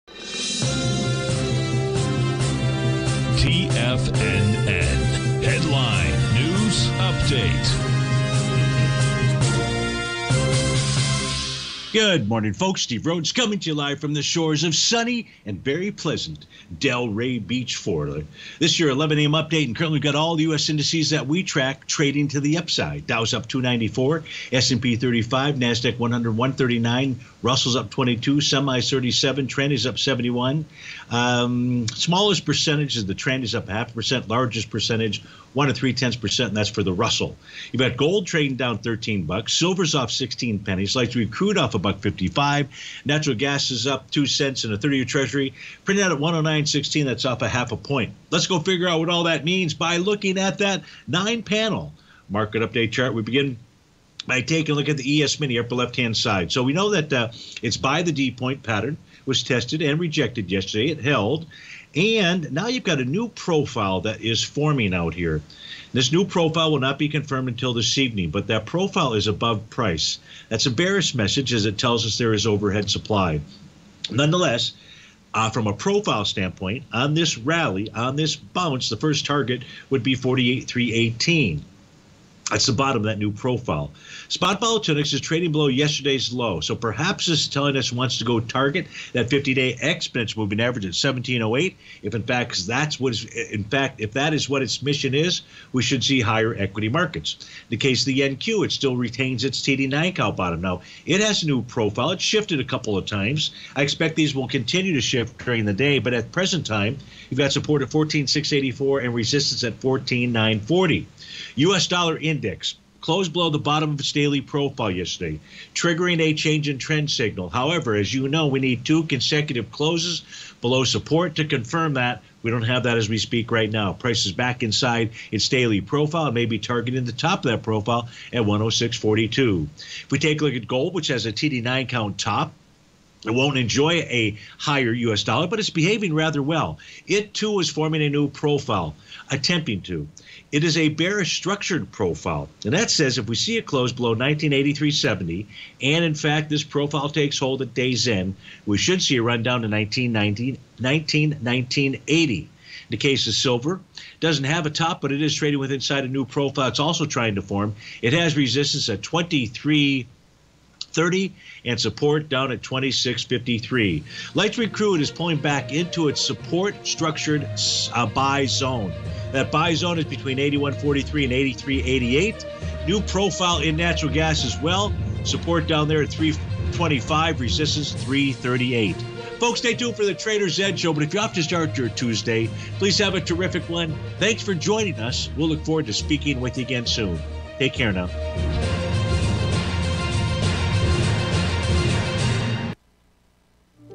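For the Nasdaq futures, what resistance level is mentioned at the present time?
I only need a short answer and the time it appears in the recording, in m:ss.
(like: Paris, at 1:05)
14940, at 1:49.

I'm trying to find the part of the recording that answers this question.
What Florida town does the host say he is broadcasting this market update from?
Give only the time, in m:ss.
0:16.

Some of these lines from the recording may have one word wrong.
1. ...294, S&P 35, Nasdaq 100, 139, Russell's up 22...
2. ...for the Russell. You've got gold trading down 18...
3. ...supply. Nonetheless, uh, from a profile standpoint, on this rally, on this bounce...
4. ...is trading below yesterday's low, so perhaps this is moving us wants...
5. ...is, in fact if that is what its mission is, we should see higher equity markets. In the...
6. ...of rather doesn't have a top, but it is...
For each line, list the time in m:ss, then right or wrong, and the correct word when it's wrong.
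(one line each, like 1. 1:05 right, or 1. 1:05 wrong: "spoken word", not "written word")
1. 0:23 right
2. 0:36 wrong: "13", not "18"
3. 1:12 right
4. 1:25 wrong: "telling", not "moving"
5. 1:33 right
6. 2:33 wrong: "silver", not "rather".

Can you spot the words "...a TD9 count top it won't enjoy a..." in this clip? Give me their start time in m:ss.
2:11.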